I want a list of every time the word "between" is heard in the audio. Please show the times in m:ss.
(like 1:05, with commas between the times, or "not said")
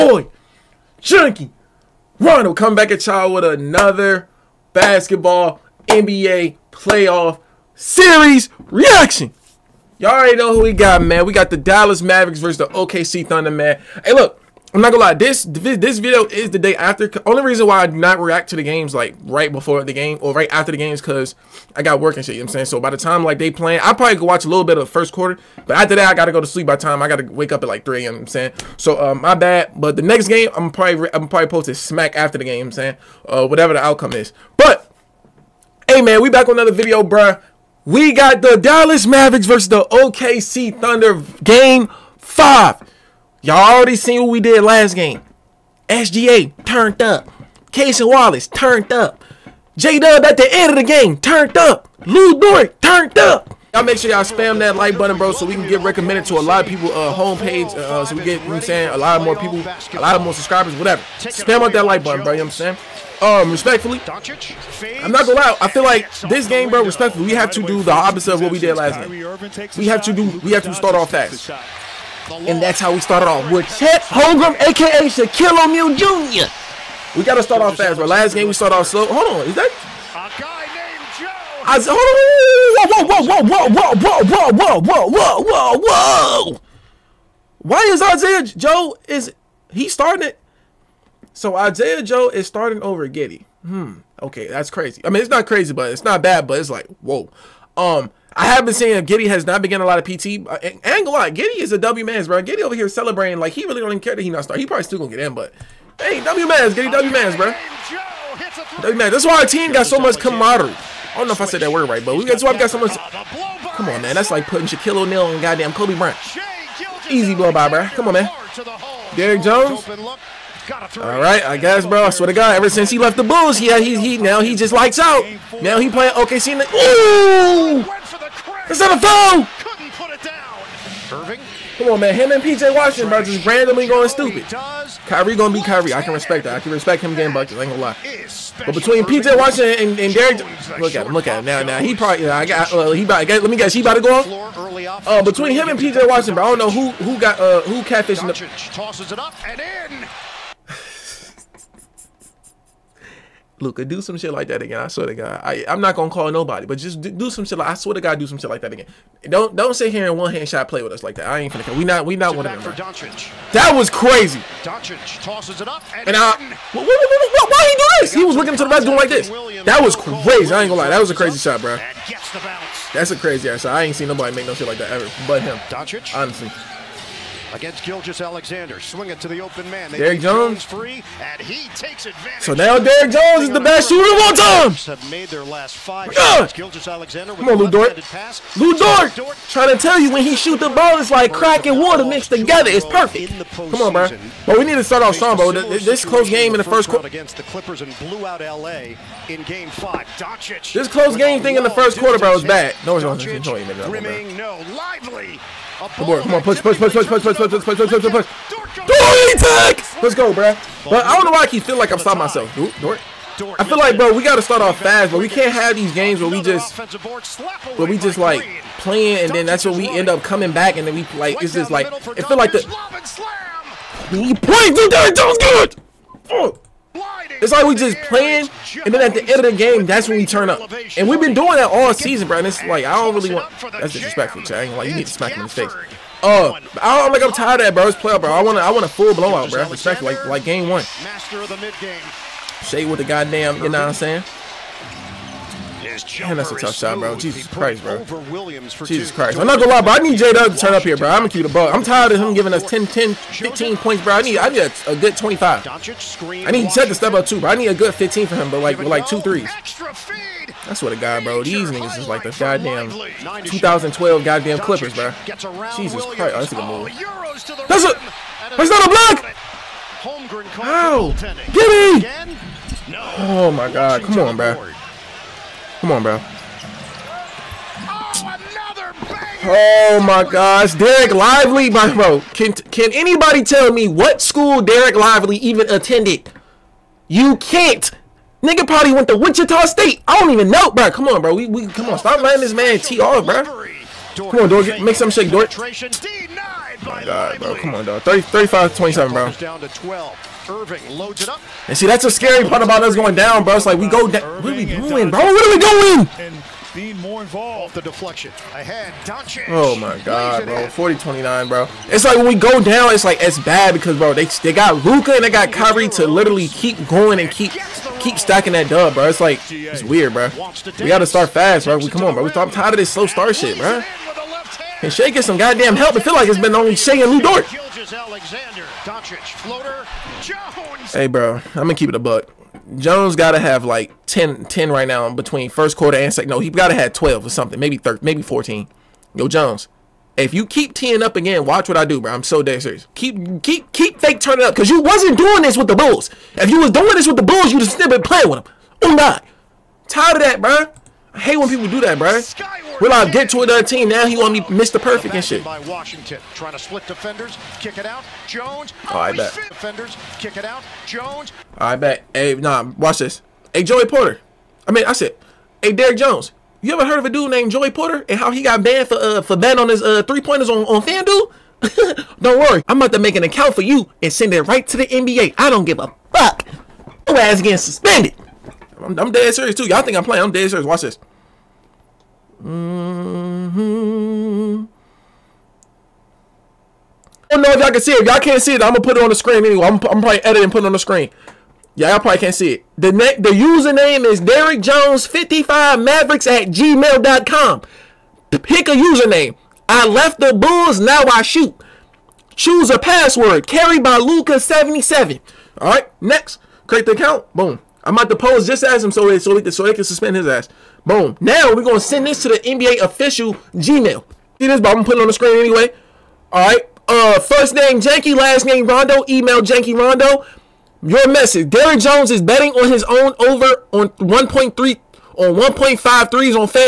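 2:18, 2:25, 5:35.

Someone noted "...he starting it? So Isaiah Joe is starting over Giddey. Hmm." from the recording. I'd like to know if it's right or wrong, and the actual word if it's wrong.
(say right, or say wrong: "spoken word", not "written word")
right.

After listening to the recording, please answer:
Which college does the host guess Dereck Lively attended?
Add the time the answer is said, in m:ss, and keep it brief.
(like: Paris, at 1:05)
Wichita State, at 4:49.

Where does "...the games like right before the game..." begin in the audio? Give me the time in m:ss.
0:18.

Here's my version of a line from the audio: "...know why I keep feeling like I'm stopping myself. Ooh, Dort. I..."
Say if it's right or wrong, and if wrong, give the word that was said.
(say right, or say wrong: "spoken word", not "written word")
right.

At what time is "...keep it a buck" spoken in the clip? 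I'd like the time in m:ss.
5:31.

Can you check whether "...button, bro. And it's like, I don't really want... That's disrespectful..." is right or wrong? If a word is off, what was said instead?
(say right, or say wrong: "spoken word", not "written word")
wrong: "season", not "button".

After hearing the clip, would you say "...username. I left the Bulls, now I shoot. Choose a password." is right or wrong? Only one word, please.
right.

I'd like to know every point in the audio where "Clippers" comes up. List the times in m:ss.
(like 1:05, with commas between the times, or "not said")
3:17, 4:24.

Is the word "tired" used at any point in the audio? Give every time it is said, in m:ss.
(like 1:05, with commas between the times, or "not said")
3:57, 4:11, 5:22, 5:49.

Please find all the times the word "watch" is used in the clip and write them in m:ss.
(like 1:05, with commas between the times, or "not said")
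0:24, 5:41, 6:02, 6:20.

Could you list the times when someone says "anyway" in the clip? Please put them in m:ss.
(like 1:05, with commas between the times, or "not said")
6:29, 6:55.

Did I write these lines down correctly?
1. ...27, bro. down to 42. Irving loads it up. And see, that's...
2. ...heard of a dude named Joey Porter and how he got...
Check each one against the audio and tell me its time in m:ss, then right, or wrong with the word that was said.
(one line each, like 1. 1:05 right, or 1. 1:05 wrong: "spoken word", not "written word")
1. 4:58 wrong: "12", not "42"
2. 6:06 right.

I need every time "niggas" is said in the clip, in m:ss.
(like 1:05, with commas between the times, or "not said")
4:21, 4:48.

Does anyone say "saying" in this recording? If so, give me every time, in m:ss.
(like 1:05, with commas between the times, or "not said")
0:22, 0:28, 0:32, 0:58, 1:02, 1:38, 4:03.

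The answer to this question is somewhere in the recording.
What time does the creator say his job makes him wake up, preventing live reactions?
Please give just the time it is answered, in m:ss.
0:27.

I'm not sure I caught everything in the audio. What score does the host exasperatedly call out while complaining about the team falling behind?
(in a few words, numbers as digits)
40-29.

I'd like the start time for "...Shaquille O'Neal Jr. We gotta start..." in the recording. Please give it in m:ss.
1:15.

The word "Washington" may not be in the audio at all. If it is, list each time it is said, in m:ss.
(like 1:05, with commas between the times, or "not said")
2:12, 2:19, 2:26, 5:55.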